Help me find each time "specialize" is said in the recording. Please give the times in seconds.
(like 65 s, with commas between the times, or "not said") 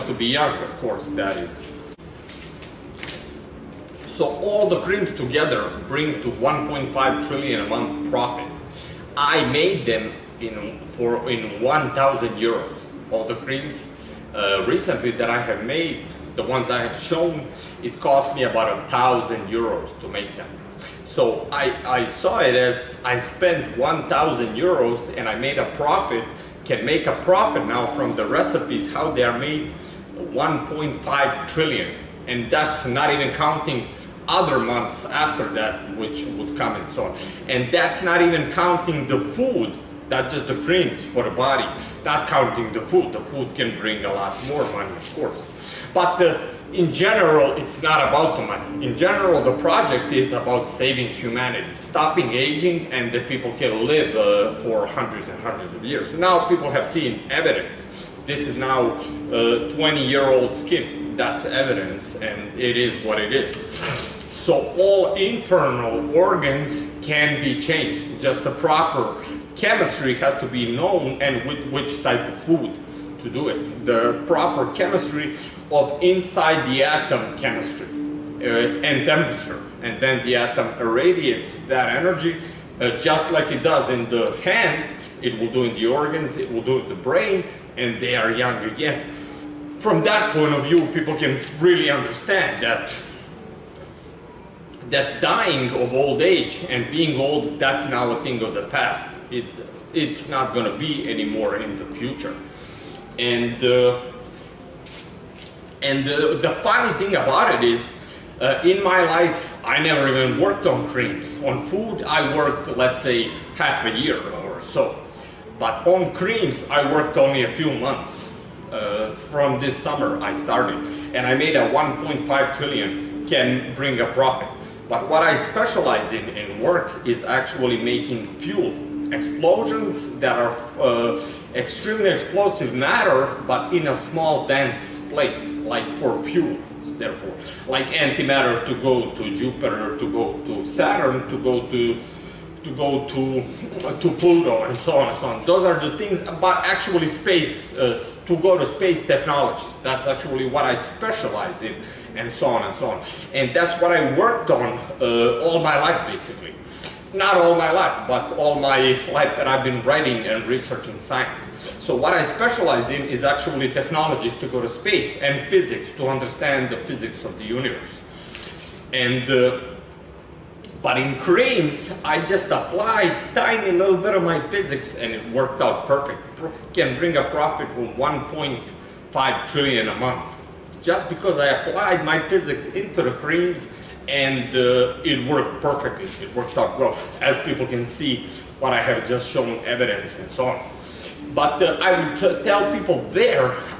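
125 s, 150 s, 162 s.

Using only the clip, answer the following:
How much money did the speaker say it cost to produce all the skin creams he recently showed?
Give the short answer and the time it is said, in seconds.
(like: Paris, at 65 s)
1,000 euros, at 18 s.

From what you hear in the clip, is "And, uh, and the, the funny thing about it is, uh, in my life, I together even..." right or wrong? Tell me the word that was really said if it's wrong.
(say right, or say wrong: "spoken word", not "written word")
wrong: "never", not "together".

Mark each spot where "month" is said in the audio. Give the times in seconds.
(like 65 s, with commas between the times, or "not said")
7 s, 34 s, 117 s, 179 s.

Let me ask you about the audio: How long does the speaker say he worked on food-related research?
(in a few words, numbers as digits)
half a year.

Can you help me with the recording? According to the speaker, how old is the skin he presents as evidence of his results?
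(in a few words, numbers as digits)
20-year-old.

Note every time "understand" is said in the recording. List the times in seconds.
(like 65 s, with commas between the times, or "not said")
91 s, 166 s.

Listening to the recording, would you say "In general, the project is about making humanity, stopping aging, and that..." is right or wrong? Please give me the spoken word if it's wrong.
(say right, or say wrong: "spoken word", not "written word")
wrong: "saving", not "making".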